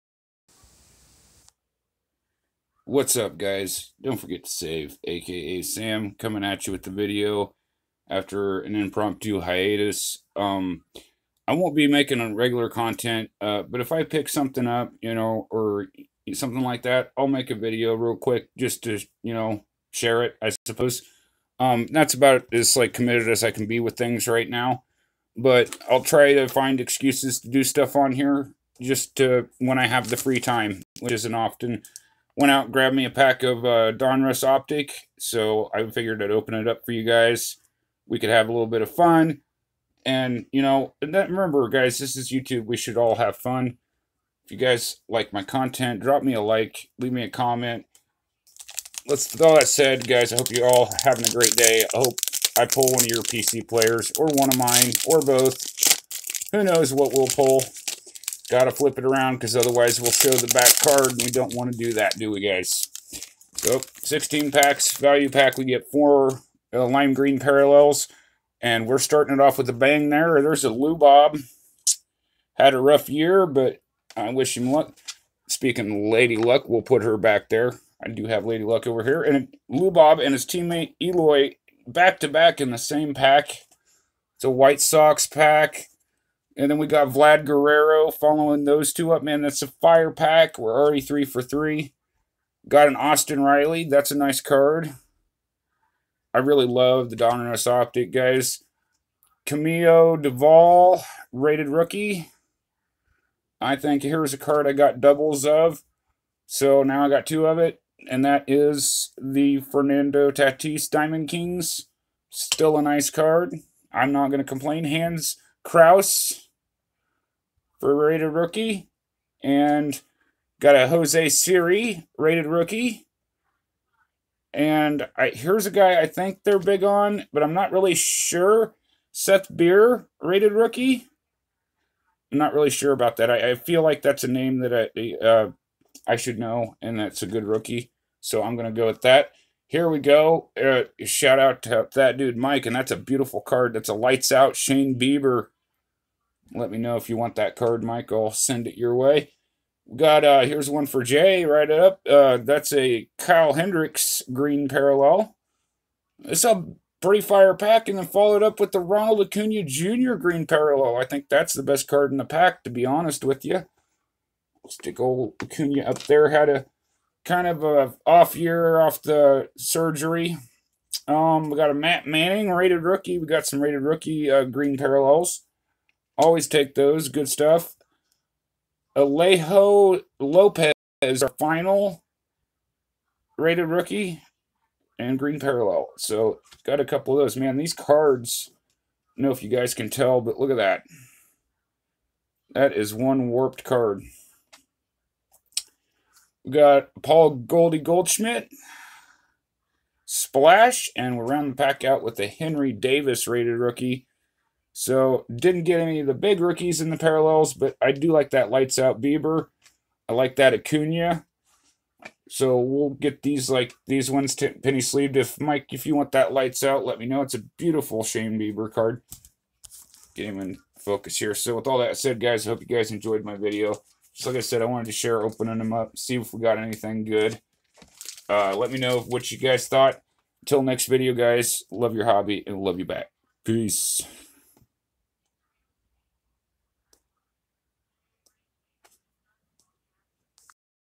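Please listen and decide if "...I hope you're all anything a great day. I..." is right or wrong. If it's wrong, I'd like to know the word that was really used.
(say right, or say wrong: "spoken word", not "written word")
wrong: "having", not "anything".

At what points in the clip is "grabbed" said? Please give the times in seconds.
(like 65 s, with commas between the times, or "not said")
32 s.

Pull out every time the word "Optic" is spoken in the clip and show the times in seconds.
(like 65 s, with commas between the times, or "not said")
34 s, 97 s.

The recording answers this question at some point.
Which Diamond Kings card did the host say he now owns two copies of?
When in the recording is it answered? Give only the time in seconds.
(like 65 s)
109 s.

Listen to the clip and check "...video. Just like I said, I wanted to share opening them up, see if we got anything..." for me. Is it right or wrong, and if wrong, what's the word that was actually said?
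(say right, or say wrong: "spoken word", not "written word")
right.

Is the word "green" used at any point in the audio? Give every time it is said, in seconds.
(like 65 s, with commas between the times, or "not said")
67 s, 154 s, 160 s, 174 s, 185 s.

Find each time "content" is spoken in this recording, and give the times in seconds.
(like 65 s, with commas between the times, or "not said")
12 s, 45 s.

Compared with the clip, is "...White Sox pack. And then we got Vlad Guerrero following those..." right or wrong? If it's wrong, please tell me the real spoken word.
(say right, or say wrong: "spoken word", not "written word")
right.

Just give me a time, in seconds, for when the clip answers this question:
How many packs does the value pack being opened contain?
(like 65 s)
64 s.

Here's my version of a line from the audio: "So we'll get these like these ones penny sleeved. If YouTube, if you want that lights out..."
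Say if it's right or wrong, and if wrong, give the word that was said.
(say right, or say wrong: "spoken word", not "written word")
wrong: "Mike", not "YouTube".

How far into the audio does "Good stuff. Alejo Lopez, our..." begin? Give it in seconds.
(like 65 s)
177 s.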